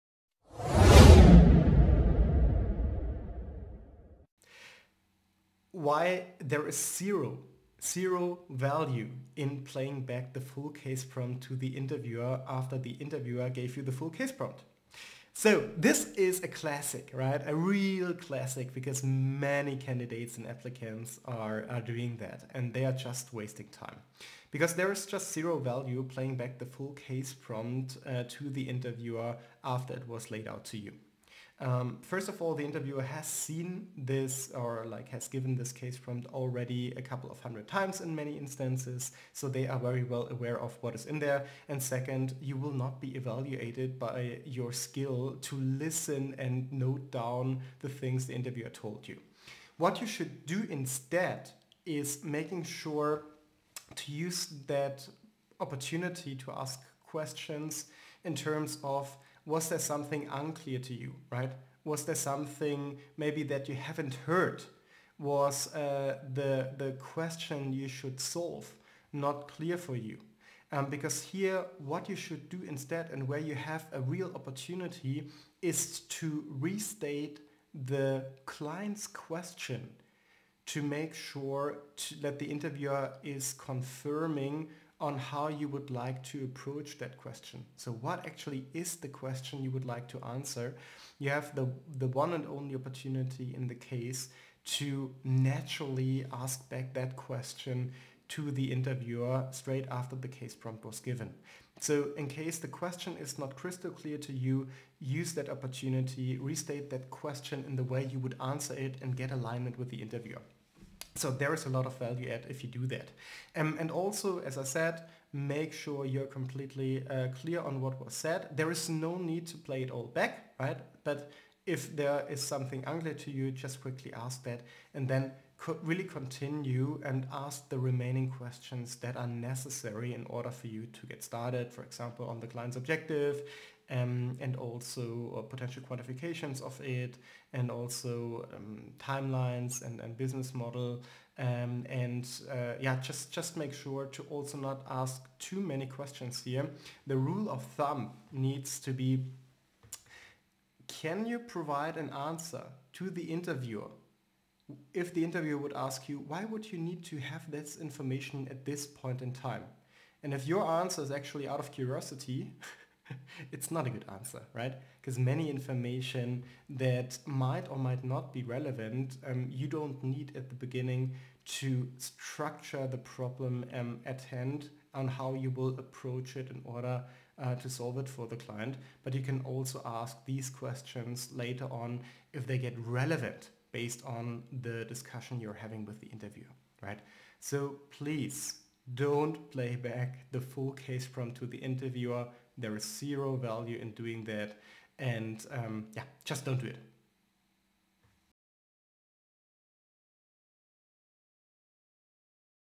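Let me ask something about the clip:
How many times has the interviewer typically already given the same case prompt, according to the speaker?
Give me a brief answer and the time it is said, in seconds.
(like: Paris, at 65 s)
a couple of hundred times, at 36 s.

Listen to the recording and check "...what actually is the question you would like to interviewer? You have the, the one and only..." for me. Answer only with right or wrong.
wrong.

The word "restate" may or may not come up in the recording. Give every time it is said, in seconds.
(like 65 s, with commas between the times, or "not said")
76 s, 106 s.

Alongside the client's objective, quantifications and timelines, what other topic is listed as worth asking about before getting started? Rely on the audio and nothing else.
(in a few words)
business model.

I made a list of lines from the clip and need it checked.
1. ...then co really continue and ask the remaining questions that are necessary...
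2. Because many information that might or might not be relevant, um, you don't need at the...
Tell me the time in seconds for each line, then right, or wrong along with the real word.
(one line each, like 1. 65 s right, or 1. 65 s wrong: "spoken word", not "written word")
1. 125 s right
2. 164 s right.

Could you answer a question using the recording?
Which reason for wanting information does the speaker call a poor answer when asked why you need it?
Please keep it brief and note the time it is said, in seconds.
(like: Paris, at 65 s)
out of curiosity, at 161 s.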